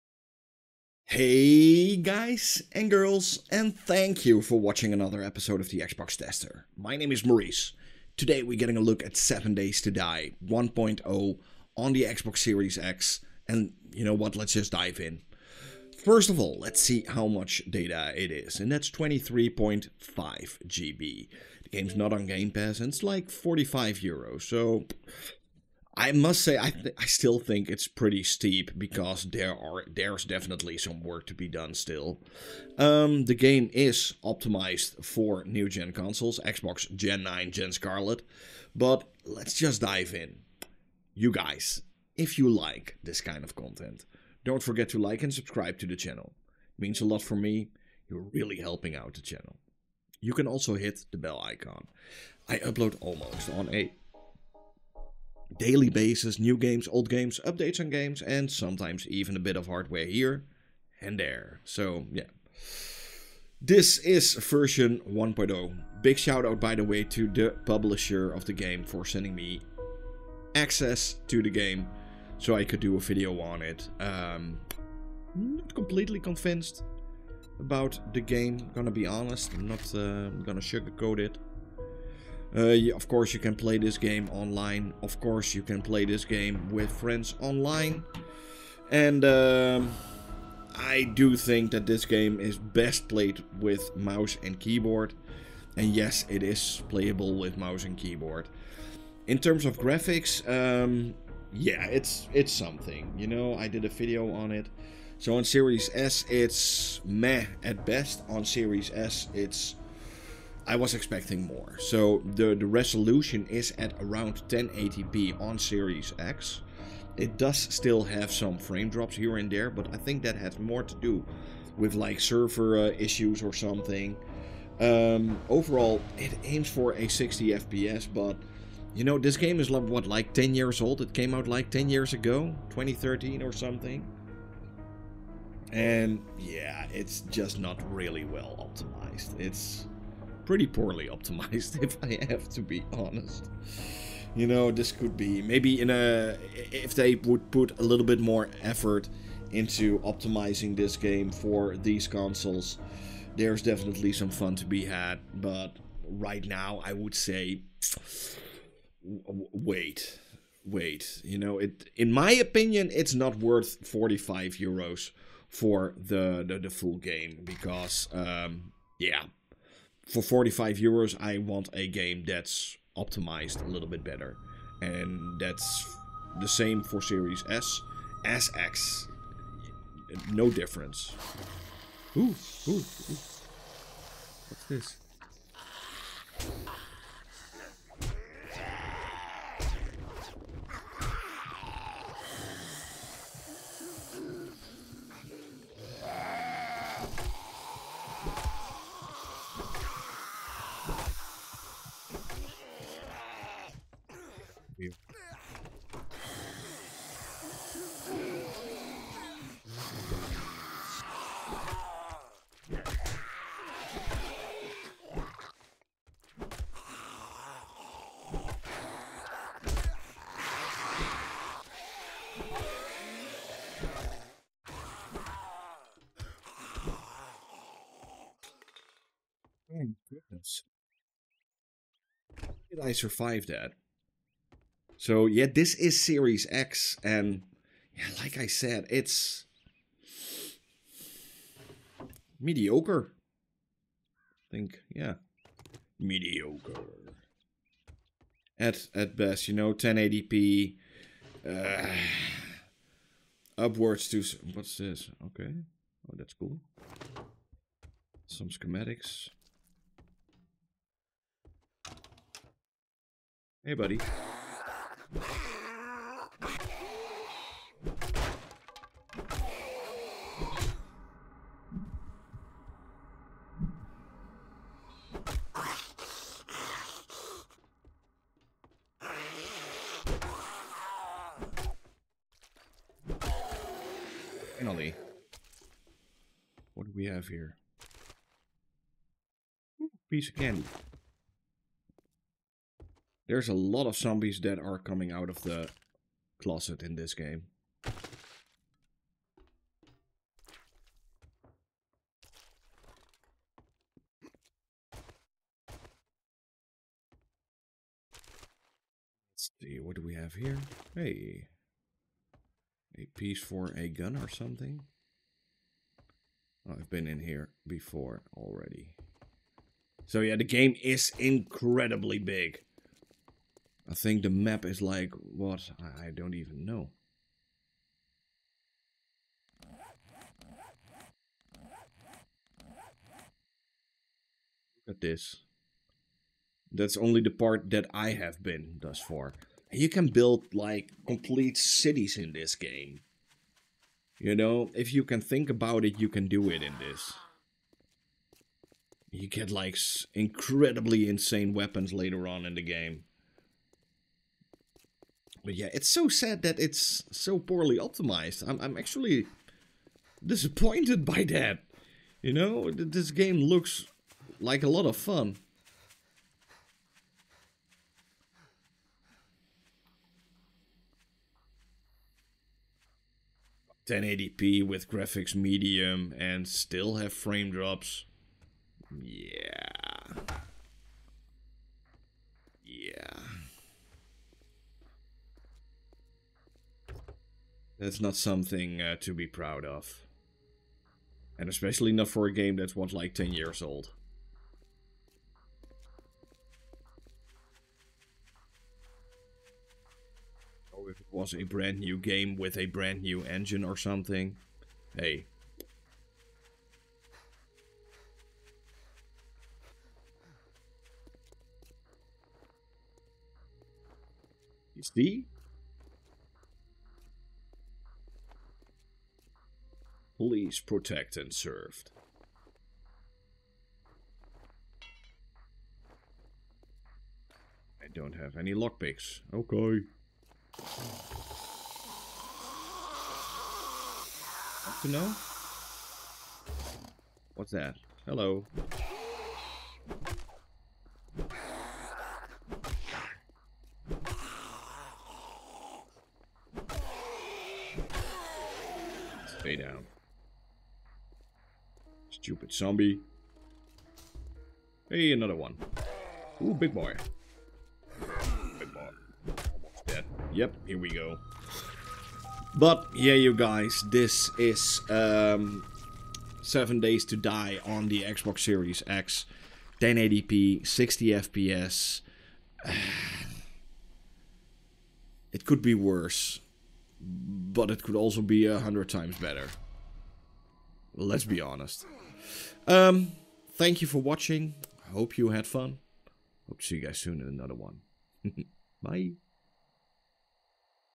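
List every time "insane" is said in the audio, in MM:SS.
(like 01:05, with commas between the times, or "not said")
05:51.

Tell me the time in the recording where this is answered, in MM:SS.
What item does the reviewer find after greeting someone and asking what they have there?
04:50.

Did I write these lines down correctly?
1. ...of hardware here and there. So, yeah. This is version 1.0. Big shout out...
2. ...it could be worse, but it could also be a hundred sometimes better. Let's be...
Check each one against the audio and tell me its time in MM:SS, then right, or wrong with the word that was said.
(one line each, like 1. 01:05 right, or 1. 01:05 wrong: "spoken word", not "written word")
1. 00:59 right
2. 07:55 wrong: "times", not "sometimes".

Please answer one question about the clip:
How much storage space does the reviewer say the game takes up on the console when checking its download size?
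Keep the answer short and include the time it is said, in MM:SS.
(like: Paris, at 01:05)
23.5 GB, at 00:18.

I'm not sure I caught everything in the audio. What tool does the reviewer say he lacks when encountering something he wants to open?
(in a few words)
lockpicks.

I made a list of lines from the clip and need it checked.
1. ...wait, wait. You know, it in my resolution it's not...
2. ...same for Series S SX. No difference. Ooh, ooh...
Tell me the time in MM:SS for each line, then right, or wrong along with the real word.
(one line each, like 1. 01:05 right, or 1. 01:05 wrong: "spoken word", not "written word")
1. 02:39 wrong: "opinion", not "resolution"
2. 02:56 right.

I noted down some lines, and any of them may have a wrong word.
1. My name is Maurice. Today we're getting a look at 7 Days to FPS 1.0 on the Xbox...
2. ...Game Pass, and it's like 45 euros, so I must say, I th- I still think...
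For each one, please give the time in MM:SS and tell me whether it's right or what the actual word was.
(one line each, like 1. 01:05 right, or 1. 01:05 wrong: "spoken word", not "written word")
1. 00:06 wrong: "Die", not "FPS"
2. 00:22 right.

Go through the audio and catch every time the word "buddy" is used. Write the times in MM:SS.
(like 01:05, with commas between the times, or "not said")
04:23.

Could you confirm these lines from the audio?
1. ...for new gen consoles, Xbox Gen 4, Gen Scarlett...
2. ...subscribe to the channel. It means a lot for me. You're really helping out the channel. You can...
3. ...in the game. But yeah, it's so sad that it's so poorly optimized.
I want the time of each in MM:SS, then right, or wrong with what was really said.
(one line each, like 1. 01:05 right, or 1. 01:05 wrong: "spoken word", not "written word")
1. 00:35 wrong: "9", not "4"
2. 00:45 right
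3. 05:52 right.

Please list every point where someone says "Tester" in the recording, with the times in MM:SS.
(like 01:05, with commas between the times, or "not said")
00:06.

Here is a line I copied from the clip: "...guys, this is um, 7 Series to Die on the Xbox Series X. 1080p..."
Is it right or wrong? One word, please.
wrong.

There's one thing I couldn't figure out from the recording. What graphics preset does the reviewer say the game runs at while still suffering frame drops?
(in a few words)
medium.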